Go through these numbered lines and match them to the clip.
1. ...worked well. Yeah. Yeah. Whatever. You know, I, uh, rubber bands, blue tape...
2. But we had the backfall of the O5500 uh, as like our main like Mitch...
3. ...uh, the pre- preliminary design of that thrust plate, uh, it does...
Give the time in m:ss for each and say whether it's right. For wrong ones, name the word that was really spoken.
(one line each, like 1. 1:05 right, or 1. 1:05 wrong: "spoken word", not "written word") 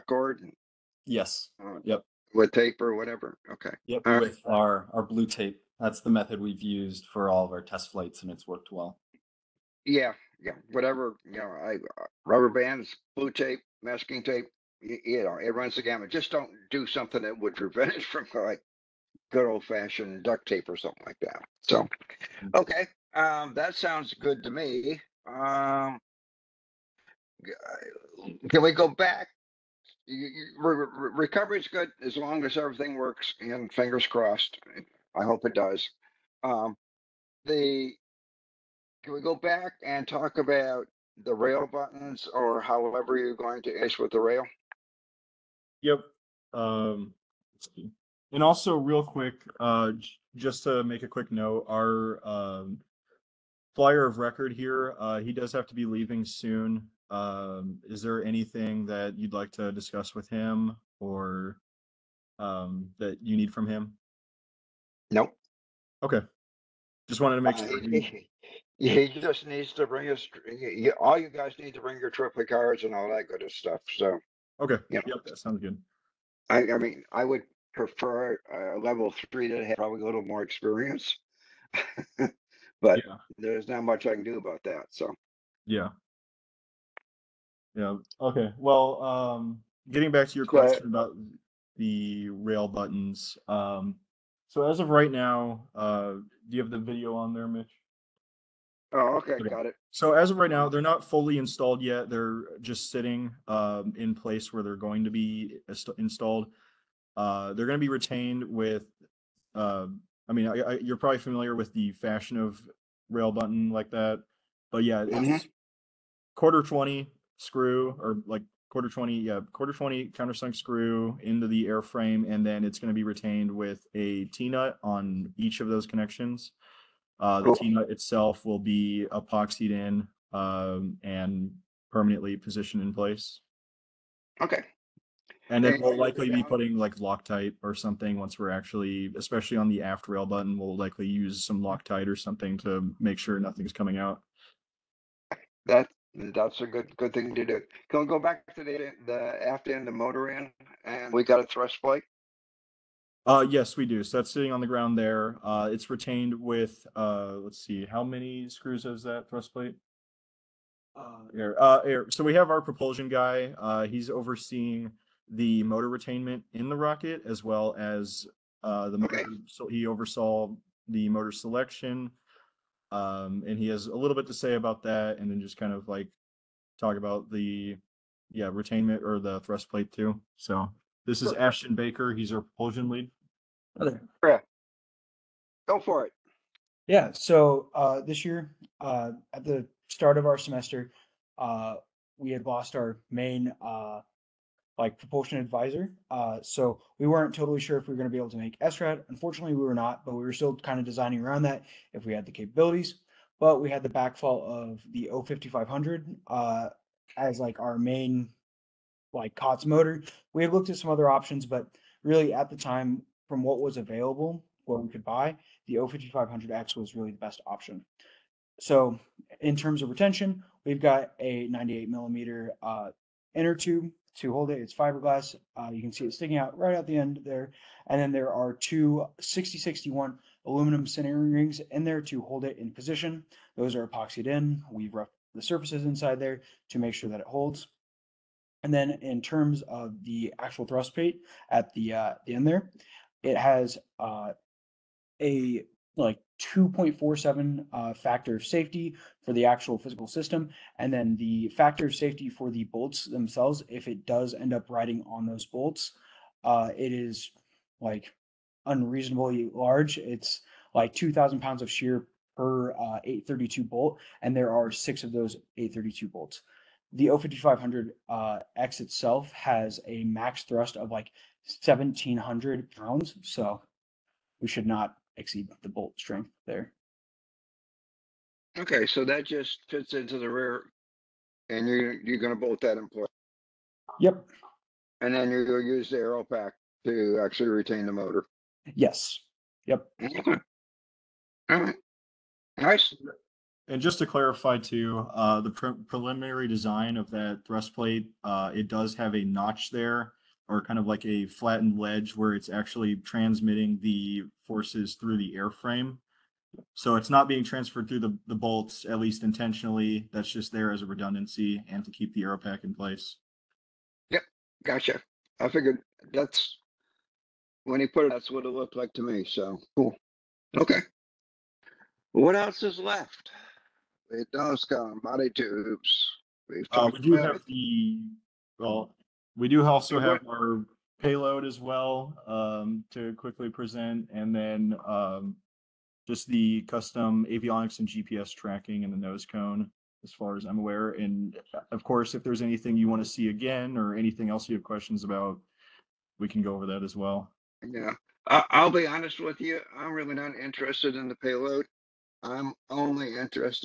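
1. 0:08 right
2. 3:23 wrong: "COTS", not "Mitch"
3. 4:55 right.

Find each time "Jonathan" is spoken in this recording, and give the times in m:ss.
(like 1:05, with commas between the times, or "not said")
not said.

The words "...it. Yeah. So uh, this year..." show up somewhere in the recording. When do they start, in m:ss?
3:06.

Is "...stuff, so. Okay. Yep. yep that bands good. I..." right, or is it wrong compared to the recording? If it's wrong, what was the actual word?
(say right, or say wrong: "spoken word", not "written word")
wrong: "sounds", not "bands".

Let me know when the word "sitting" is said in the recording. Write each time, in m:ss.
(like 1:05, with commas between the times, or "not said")
1:42, 2:34.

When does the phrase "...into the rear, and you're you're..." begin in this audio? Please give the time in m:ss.
4:39.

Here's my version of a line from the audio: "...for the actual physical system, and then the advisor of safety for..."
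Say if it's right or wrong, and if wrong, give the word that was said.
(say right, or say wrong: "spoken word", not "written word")
wrong: "factor", not "advisor".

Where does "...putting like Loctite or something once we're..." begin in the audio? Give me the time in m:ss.
2:16.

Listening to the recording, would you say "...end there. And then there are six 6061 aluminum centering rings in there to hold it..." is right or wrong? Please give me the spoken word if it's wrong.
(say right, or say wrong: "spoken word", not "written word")
wrong: "two", not "six".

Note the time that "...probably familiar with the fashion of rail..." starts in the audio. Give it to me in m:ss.
1:50.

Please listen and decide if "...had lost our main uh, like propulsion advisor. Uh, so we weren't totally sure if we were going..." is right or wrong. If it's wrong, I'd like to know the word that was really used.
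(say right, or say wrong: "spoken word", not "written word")
right.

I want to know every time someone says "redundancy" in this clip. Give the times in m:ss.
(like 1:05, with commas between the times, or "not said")
5:10.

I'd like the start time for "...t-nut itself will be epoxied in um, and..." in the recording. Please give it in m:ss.
2:07.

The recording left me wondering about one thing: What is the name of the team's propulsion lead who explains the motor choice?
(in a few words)
Ashton Baker.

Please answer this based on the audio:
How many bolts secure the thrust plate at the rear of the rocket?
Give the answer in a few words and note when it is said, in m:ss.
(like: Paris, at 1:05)
6, at 4:24.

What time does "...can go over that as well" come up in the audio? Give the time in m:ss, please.
5:46.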